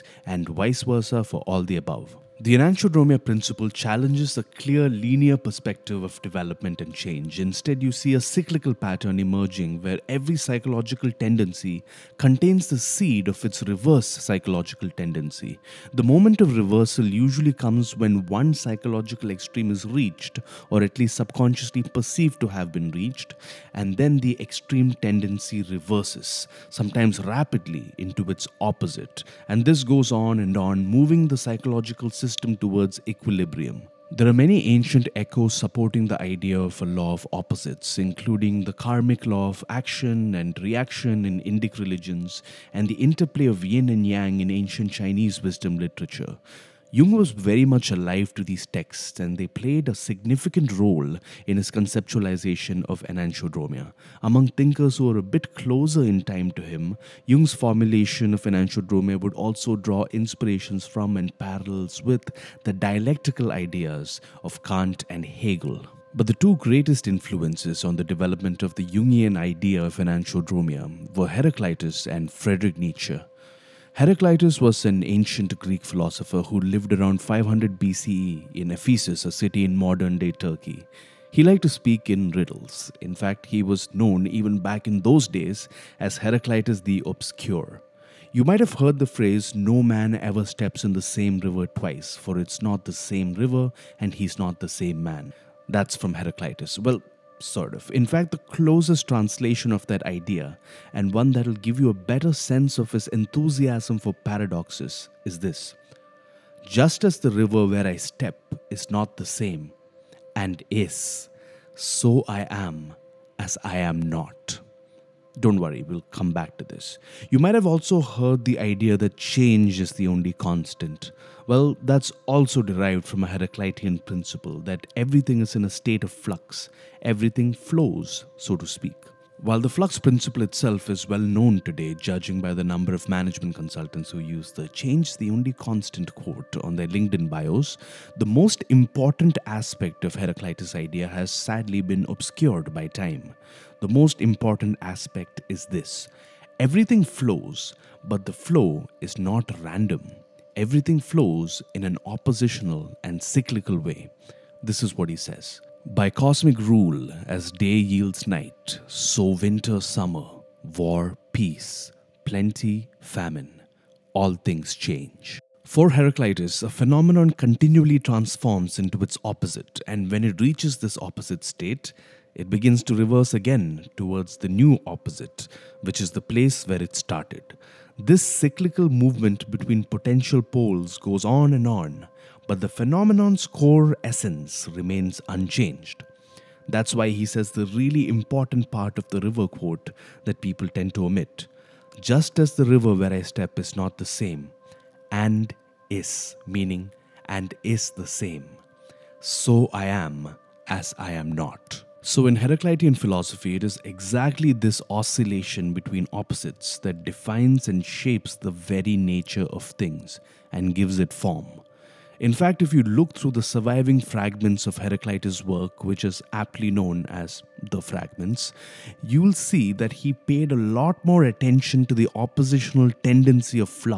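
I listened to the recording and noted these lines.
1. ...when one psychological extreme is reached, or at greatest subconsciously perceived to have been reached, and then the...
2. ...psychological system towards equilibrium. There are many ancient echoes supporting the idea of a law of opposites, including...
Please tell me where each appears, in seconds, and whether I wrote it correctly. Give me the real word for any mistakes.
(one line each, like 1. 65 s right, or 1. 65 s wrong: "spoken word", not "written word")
1. 17 s wrong: "least", not "greatest"
2. 31 s right.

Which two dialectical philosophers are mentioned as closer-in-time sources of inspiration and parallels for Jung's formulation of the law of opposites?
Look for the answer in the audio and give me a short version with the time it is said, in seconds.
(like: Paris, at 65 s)
Kant and Hegel, at 64 s.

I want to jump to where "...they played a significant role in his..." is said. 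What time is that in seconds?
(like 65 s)
49 s.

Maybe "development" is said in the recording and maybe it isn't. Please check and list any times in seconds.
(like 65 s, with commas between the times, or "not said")
6 s, 68 s.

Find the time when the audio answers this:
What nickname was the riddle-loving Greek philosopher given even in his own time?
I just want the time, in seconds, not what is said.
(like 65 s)
86 s.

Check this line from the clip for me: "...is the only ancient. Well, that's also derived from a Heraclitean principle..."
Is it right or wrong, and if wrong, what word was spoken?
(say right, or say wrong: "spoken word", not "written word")
wrong: "constant", not "ancient".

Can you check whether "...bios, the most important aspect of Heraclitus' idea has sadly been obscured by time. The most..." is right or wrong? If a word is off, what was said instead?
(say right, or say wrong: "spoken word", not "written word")
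right.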